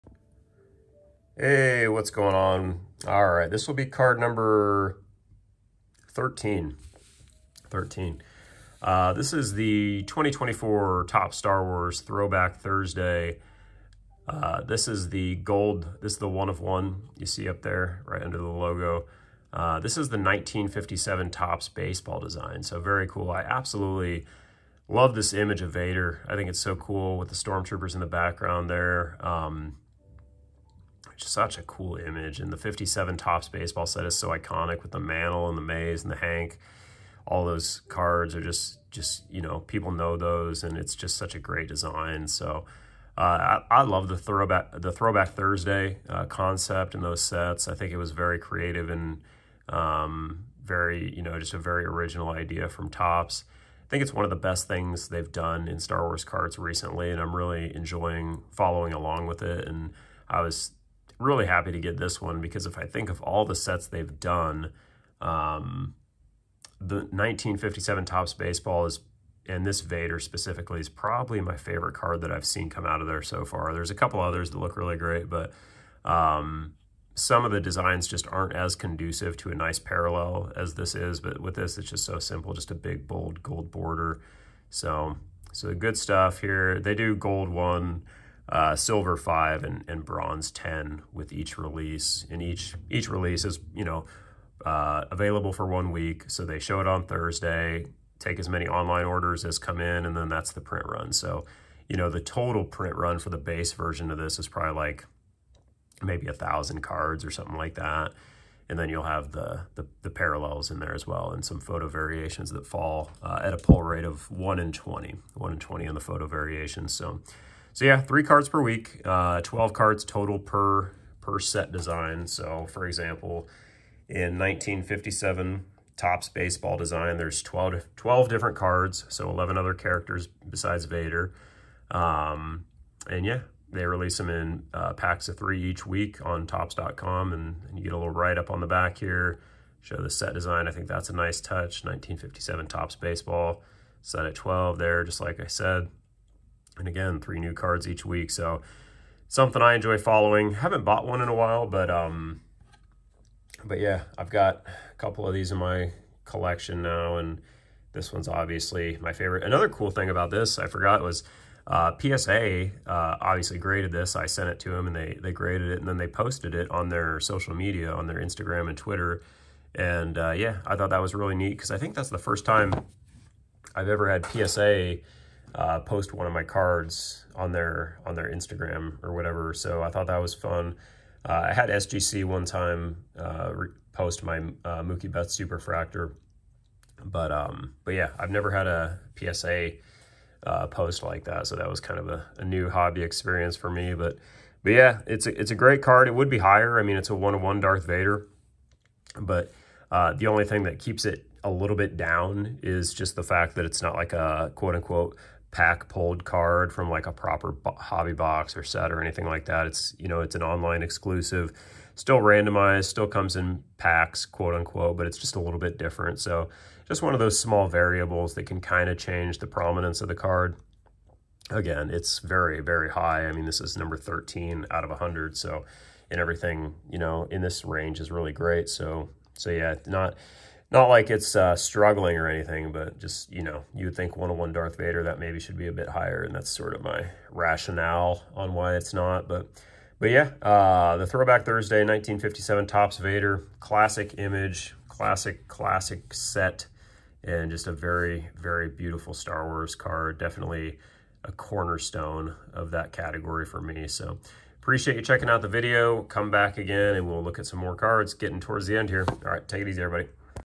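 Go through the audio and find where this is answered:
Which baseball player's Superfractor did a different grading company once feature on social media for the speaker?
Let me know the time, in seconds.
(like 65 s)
184 s.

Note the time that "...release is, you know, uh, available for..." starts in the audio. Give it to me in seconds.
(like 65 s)
93 s.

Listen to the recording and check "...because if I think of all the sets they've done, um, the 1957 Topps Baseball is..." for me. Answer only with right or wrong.
right.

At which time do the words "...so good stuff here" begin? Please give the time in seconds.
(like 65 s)
85 s.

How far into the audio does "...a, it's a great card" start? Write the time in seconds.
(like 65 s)
195 s.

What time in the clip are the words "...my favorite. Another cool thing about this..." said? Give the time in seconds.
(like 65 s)
158 s.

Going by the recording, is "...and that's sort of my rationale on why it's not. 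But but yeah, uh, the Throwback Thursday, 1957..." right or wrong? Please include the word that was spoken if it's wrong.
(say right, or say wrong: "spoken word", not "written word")
right.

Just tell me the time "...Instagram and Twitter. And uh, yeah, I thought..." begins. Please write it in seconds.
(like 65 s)
168 s.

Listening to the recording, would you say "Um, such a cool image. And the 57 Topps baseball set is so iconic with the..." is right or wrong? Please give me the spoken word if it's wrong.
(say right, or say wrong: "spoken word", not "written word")
right.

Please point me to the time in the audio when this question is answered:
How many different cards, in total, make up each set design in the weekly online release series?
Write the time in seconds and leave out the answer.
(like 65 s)
119 s.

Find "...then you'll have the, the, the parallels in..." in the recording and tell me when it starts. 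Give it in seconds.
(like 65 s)
108 s.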